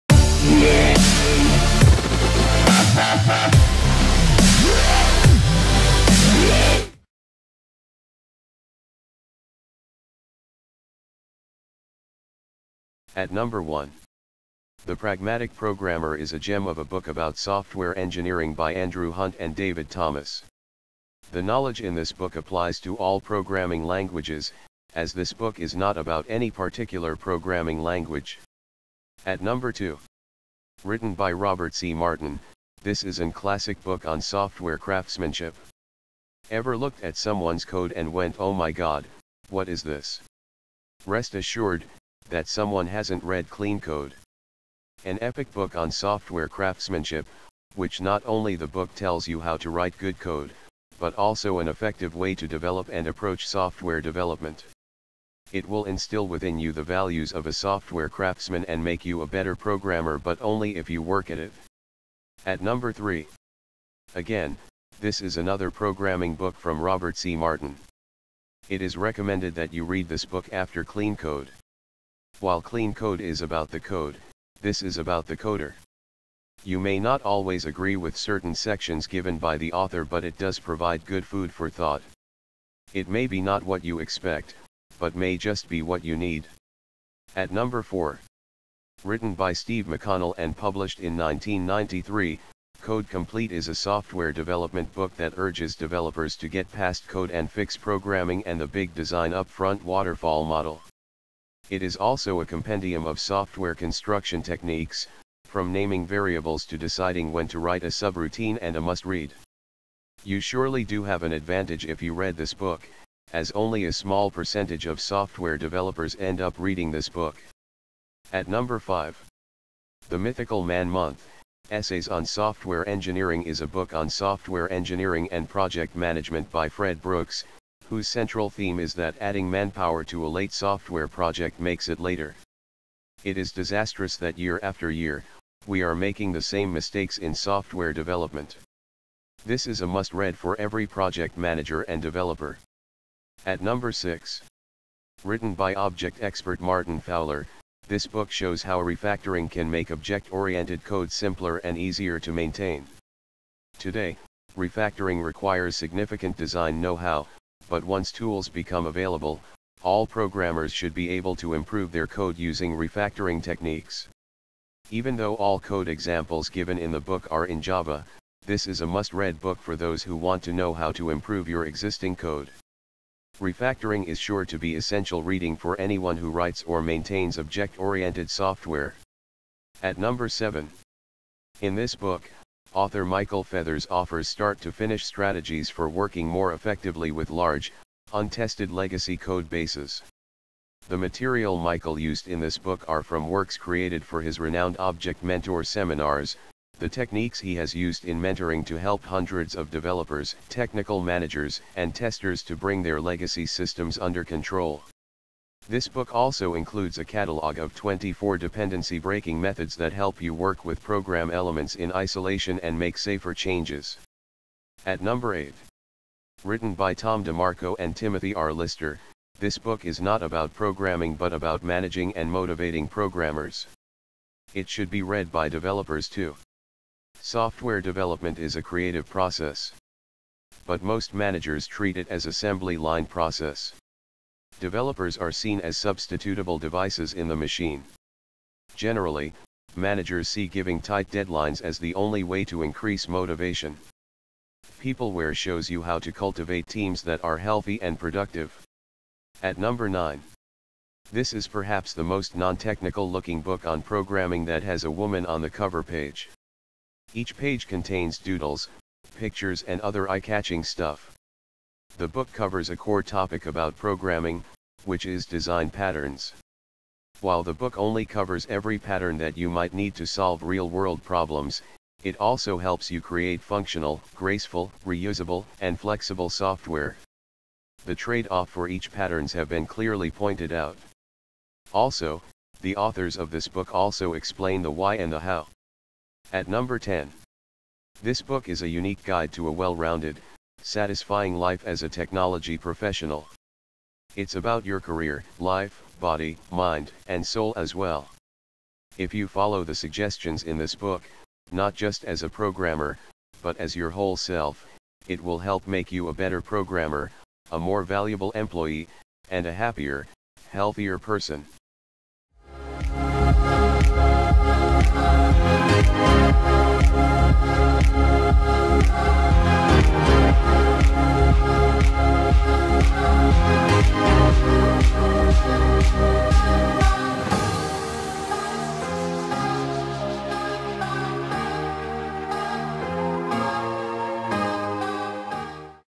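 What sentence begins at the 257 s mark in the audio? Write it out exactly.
Each page contains doodles, pictures and other eye-catching stuff.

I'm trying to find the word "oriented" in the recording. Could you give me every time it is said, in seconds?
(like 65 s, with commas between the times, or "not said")
149 s, 177 s.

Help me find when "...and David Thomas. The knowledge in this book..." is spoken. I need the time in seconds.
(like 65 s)
19 s.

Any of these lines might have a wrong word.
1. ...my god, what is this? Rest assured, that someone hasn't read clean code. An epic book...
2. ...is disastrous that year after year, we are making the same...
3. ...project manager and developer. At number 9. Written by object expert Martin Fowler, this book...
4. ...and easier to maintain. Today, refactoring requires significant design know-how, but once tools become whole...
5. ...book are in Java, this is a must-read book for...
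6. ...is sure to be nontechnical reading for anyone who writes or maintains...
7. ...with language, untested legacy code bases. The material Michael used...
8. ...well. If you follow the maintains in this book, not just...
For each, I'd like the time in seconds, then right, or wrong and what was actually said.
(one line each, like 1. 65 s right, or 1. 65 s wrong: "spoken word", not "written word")
1. 38 s right
2. 133 s right
3. 140 s wrong: "6", not "9"
4. 151 s wrong: "available", not "whole"
5. 166 s right
6. 174 s wrong: "essential", not "nontechnical"
7. 187 s wrong: "large", not "language"
8. 297 s wrong: "suggestions", not "maintains".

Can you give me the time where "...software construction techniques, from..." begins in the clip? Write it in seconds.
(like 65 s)
103 s.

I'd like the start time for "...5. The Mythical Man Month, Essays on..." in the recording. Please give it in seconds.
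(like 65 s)
118 s.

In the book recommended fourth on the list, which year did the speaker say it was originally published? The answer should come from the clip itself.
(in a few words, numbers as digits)
1993.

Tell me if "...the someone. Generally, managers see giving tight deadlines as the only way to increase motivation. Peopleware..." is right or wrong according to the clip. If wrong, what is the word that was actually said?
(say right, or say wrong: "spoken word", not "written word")
wrong: "machine", not "someone".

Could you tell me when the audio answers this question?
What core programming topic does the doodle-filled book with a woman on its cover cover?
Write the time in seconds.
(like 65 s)
265 s.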